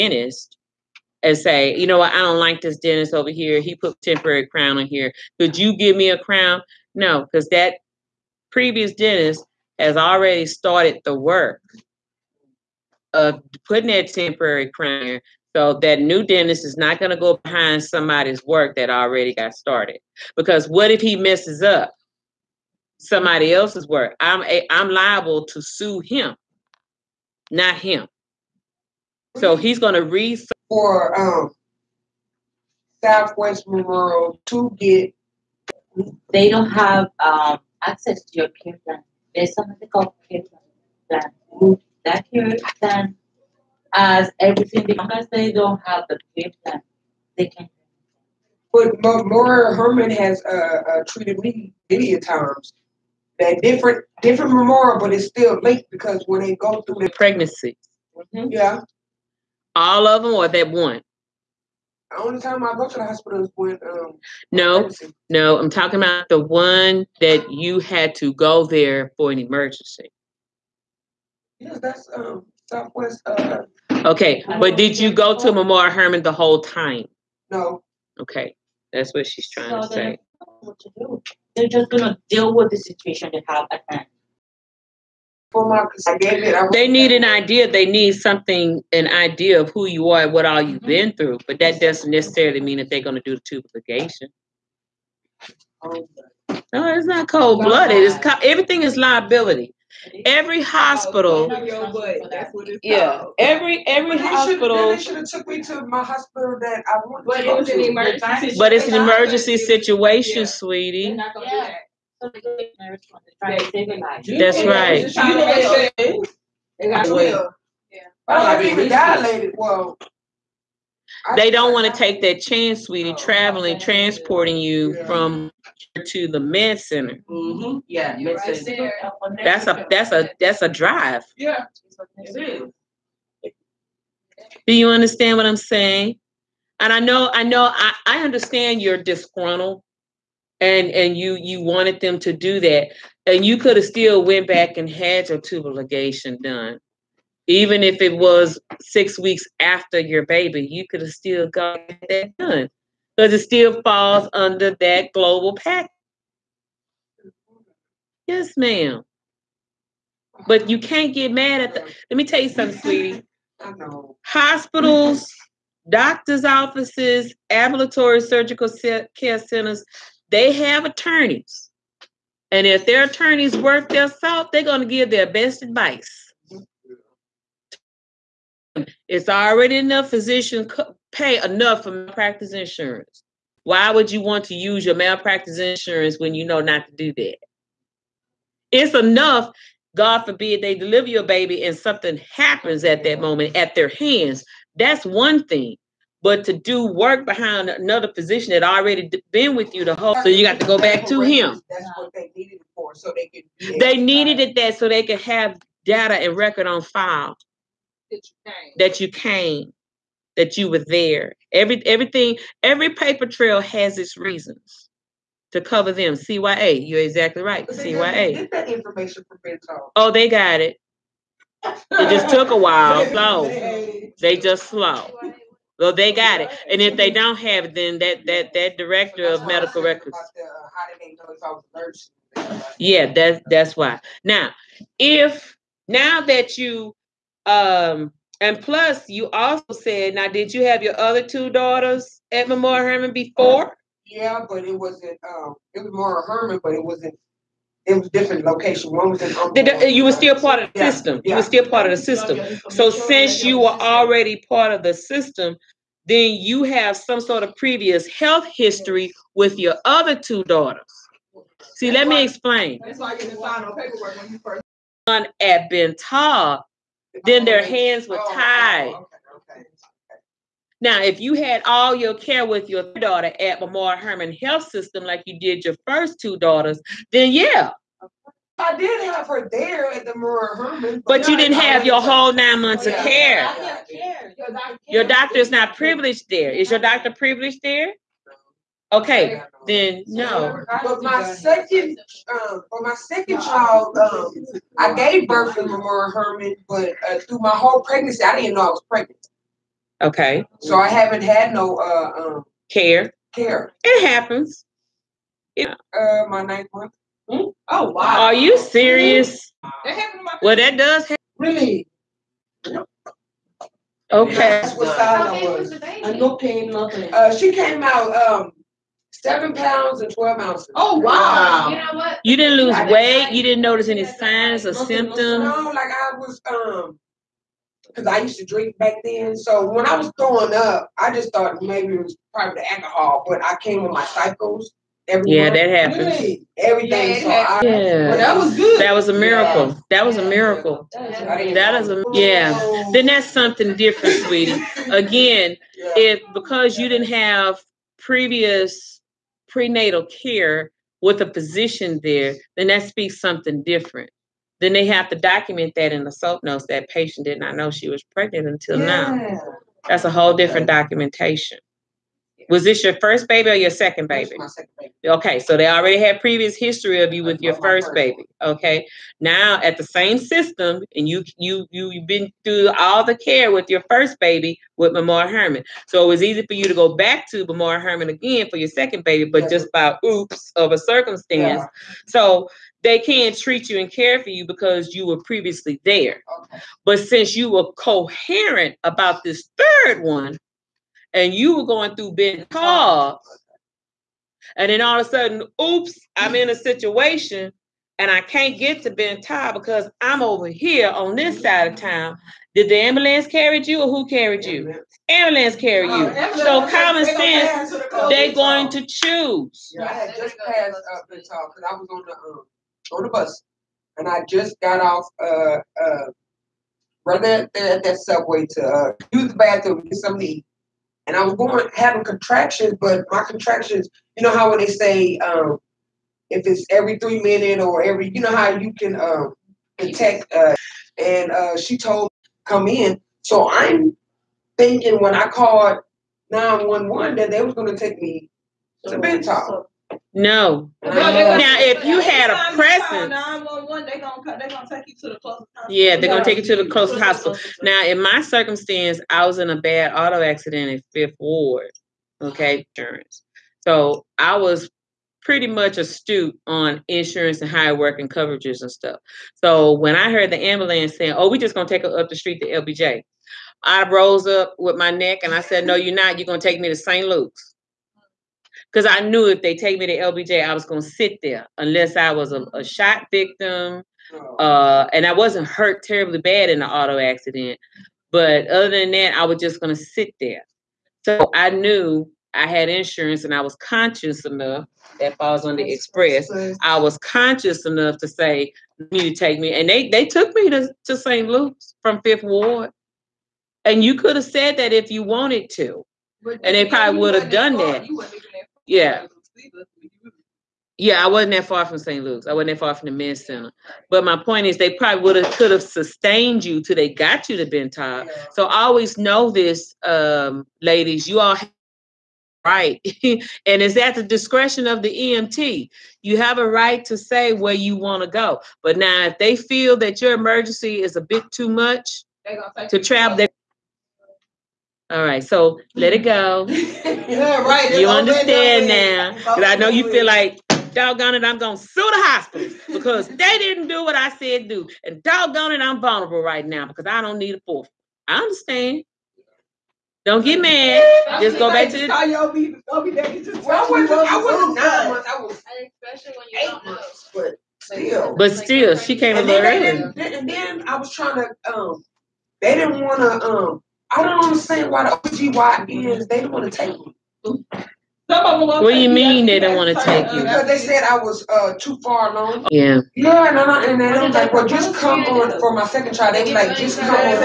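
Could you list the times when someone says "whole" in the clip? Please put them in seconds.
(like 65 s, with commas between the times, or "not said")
76 s, 199 s, 282 s, 297 s, 360 s.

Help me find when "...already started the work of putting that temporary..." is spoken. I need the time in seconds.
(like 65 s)
9 s.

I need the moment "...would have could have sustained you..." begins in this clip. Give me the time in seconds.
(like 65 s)
505 s.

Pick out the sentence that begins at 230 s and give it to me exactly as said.
The, uh, yeah, that's that's why.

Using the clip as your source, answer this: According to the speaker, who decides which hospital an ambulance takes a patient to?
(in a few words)
the EMT.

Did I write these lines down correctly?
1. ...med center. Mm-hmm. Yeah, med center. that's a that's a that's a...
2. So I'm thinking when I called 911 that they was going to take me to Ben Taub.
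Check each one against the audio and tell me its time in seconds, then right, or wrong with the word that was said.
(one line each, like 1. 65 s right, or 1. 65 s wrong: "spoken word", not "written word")
1. 126 s right
2. 433 s right.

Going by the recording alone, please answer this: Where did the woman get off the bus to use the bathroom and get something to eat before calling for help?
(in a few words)
Subway.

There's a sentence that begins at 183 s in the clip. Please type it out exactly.
Why would you want to use your malpractice insurance when you know not to do that?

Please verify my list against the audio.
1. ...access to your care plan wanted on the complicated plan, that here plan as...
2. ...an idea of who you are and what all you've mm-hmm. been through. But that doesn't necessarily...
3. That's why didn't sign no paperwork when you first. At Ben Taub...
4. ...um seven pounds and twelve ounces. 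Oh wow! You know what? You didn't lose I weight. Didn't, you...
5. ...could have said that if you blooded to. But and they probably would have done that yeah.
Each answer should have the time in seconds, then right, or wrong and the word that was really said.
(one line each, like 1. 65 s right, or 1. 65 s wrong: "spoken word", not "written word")
1. 37 s wrong: "based", not "wanted"
2. 88 s right
3. 262 s right
4. 318 s right
5. 493 s wrong: "wanted", not "blooded".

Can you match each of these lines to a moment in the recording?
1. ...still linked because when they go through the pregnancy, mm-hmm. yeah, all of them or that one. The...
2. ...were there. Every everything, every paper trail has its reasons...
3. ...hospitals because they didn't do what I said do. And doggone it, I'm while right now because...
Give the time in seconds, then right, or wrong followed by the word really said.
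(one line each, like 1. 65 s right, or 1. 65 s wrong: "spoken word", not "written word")
1. 55 s right
2. 210 s right
3. 532 s wrong: "vulnerable", not "while".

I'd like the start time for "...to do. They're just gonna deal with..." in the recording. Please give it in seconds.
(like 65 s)
80 s.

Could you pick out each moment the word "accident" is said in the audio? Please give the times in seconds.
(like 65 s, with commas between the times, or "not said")
450 s, 476 s.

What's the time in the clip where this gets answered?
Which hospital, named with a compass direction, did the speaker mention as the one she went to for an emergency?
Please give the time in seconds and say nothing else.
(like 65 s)
33 s.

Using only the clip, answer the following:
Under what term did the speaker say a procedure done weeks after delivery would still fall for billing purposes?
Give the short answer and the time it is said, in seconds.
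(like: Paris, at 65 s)
global pack, at 155 s.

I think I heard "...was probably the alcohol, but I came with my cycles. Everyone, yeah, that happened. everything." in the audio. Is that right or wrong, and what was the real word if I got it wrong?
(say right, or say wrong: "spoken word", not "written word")
right.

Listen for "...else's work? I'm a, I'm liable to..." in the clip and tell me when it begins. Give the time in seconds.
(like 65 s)
23 s.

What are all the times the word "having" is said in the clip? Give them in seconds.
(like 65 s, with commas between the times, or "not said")
421 s.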